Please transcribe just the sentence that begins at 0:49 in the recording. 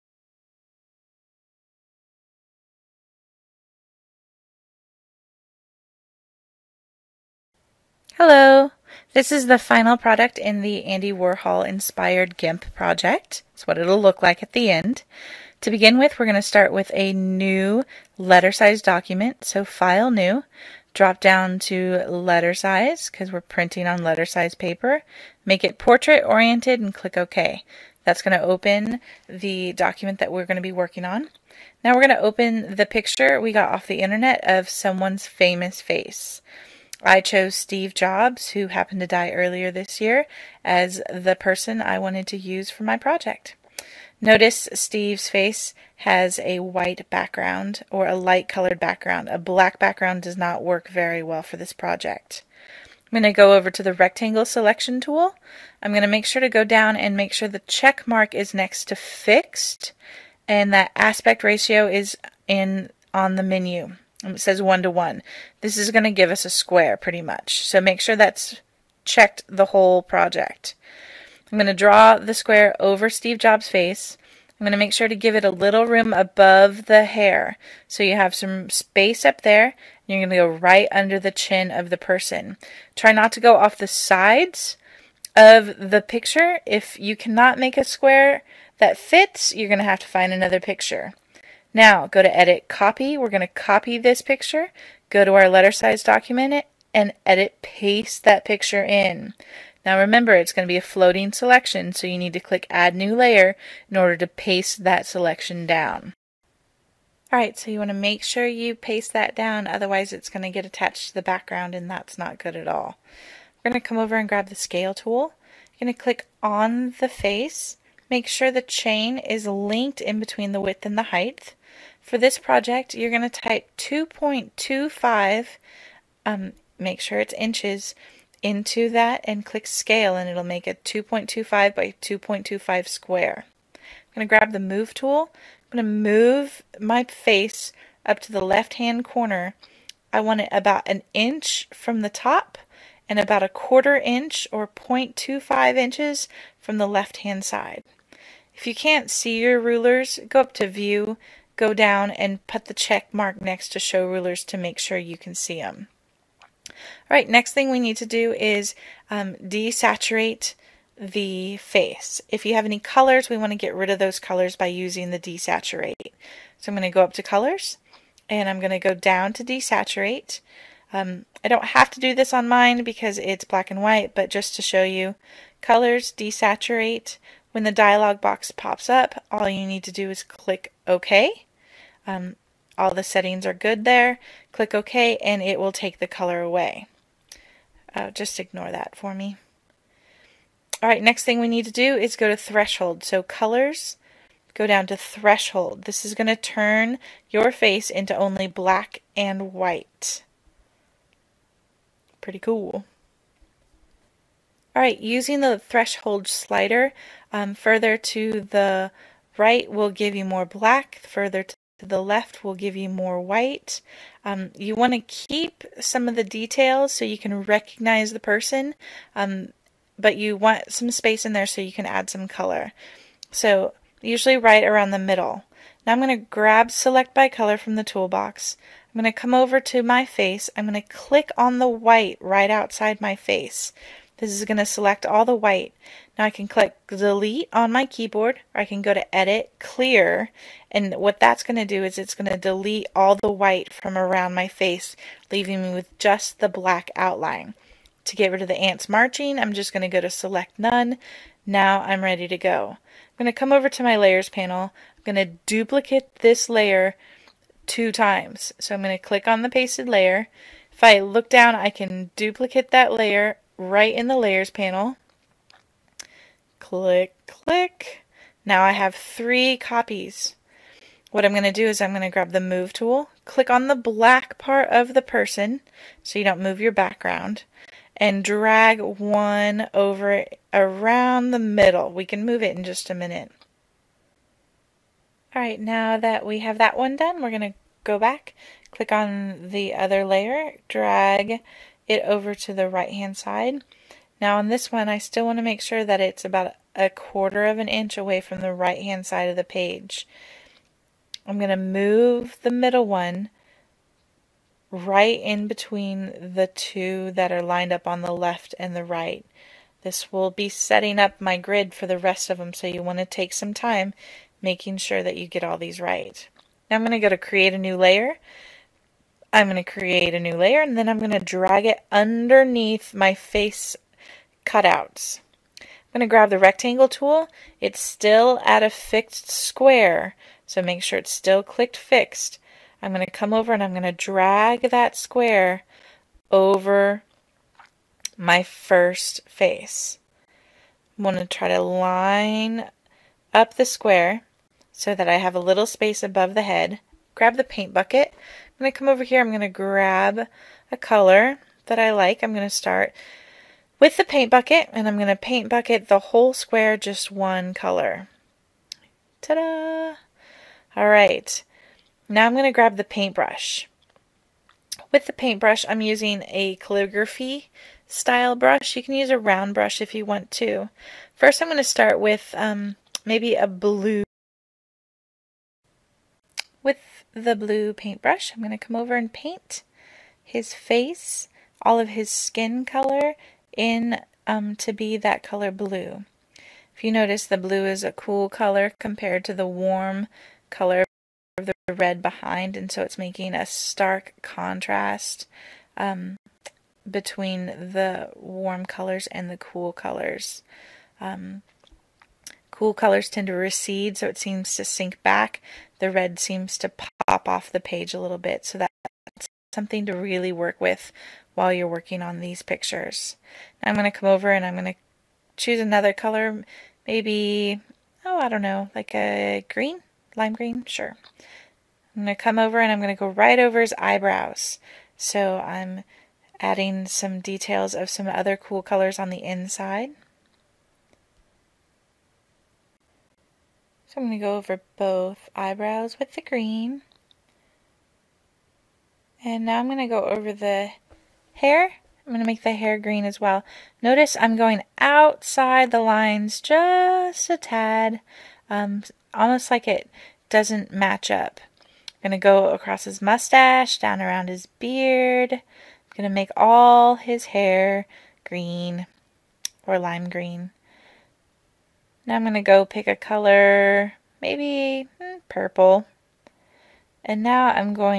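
A black background does not work very well for this project.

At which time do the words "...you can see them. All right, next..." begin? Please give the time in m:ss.
2:34.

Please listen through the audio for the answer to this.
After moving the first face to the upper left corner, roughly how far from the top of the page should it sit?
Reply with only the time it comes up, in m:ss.
2:20.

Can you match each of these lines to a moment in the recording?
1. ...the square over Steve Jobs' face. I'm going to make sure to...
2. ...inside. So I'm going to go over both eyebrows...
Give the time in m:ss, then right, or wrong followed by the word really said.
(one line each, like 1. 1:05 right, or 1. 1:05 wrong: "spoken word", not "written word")
1. 1:12 right
2. 7:09 right.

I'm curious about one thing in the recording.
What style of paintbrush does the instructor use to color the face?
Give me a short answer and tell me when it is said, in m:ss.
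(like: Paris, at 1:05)
calligraphy, at 6:06.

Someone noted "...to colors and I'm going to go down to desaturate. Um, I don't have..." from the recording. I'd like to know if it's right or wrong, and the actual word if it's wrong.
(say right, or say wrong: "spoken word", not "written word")
right.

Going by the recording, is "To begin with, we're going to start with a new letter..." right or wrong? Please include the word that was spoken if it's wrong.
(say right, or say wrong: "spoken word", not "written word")
right.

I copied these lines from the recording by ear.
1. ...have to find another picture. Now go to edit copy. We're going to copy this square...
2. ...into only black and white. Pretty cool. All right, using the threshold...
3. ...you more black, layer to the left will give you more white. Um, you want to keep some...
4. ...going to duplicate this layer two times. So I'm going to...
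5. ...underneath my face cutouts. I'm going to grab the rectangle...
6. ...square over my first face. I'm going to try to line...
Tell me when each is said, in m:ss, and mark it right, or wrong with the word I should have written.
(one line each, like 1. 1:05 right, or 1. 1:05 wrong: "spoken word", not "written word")
1. 1:29 wrong: "picture", not "square"
2. 3:17 right
3. 3:30 wrong: "further", not "layer"
4. 4:15 right
5. 5:21 right
6. 5:34 right.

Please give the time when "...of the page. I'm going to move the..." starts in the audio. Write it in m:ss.
4:59.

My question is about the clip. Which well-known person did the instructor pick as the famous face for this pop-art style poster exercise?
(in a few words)
Steve Jobs.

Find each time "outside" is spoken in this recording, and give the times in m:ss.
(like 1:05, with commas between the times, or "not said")
3:52, 7:24.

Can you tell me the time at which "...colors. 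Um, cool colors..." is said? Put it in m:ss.
6:39.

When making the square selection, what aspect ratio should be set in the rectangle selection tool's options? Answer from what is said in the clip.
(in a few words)
1 to 1.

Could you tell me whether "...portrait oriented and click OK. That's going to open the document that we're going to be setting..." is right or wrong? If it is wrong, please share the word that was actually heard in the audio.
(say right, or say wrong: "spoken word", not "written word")
wrong: "working", not "setting".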